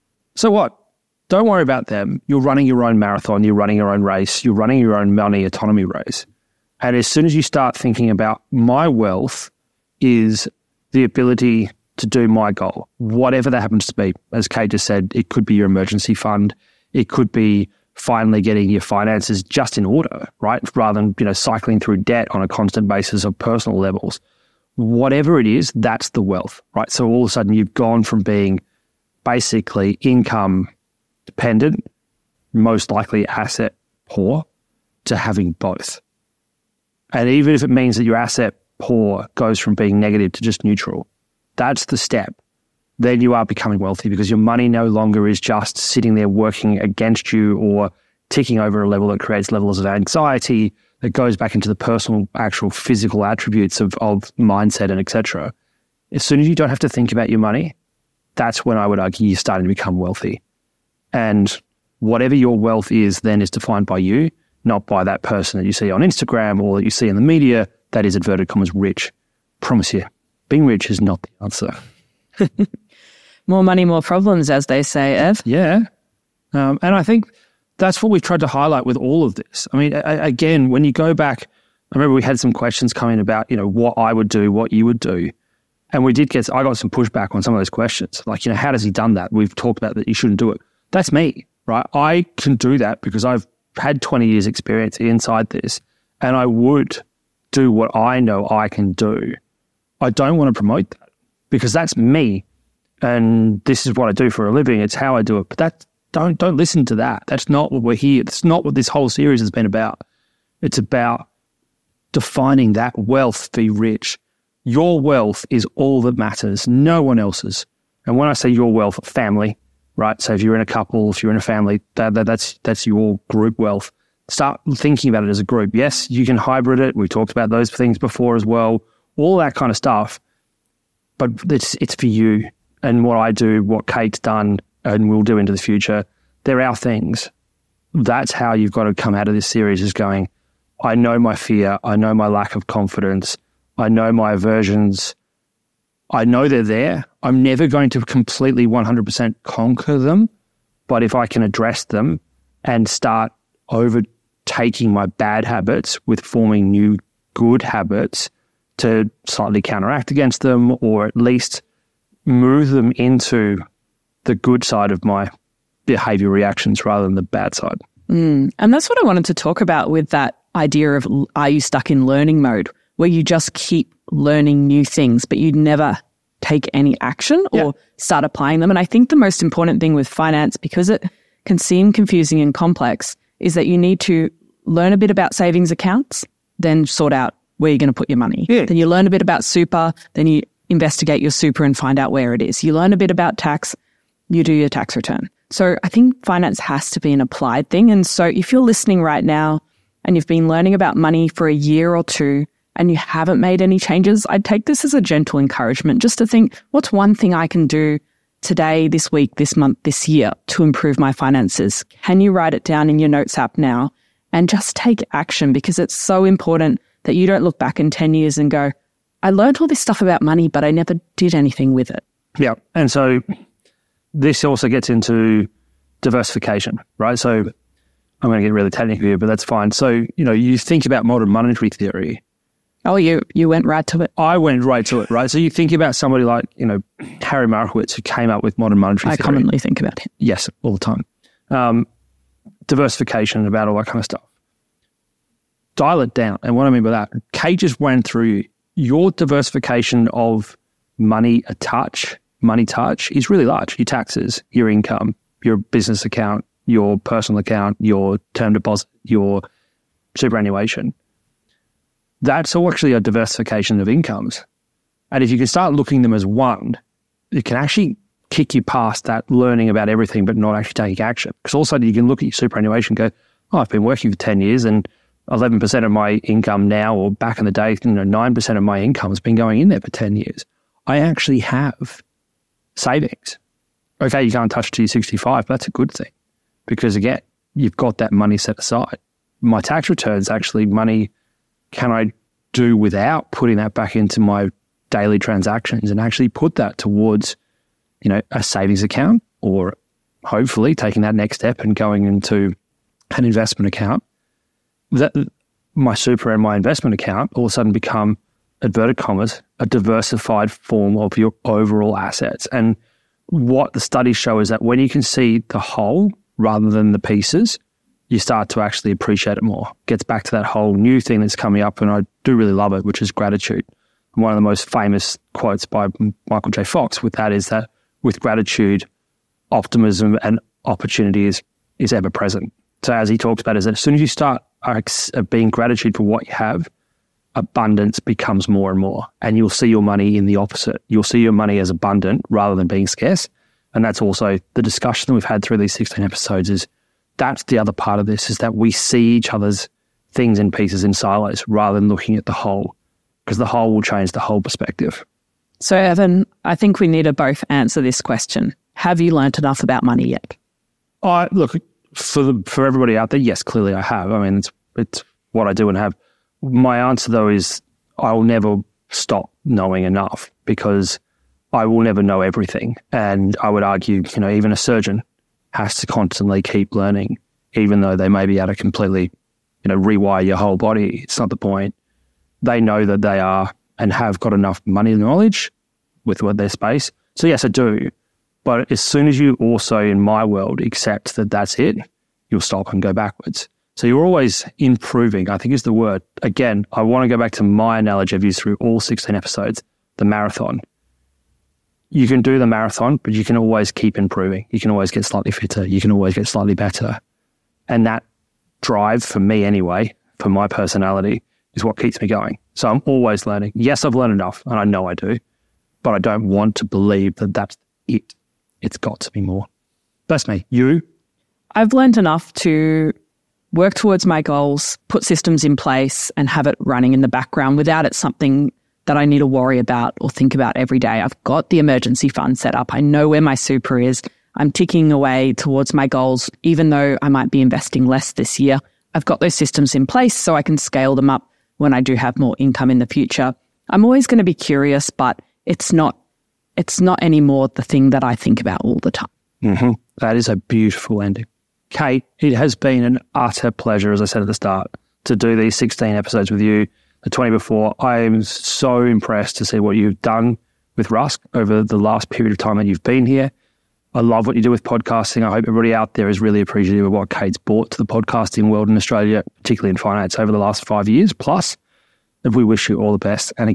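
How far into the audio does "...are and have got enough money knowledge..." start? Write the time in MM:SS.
06:23.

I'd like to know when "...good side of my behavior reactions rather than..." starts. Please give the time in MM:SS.
02:44.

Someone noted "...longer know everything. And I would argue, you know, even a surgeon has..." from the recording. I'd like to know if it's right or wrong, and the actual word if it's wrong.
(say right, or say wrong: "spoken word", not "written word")
wrong: "never", not "longer".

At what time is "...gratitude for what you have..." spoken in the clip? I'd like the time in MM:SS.
05:35.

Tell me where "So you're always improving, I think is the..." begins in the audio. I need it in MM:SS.
06:33.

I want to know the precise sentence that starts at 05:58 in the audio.
Have you learnt enough about money yet?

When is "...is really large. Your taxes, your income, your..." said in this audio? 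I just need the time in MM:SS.
04:13.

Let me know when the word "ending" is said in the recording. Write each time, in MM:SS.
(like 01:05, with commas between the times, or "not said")
07:31.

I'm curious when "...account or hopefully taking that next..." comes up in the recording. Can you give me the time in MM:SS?
04:58.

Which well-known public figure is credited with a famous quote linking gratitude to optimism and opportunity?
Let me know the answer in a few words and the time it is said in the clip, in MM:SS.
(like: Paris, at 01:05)
Michael J. Fox, at 05:26.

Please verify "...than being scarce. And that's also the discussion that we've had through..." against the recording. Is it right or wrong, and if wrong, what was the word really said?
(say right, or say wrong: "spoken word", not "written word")
right.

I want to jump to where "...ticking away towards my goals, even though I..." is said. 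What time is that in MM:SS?
07:14.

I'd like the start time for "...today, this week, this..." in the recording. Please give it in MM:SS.
03:28.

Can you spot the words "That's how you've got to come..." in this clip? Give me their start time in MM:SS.
02:17.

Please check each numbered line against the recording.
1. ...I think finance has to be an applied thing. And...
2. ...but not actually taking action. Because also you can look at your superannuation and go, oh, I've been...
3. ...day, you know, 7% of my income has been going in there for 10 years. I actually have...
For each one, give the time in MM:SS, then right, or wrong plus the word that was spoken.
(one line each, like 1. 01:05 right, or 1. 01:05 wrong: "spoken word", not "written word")
1. 03:15 right
2. 04:30 right
3. 04:37 wrong: "9", not "7".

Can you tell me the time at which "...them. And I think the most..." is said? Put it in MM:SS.
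02:58.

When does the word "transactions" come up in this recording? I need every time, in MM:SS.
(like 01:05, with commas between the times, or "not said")
04:55.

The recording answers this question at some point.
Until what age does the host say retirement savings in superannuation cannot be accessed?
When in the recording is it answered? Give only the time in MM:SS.
04:44.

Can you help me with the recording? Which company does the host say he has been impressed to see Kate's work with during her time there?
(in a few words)
Rask.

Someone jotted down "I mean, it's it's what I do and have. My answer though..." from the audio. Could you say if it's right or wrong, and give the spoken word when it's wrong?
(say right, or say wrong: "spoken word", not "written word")
right.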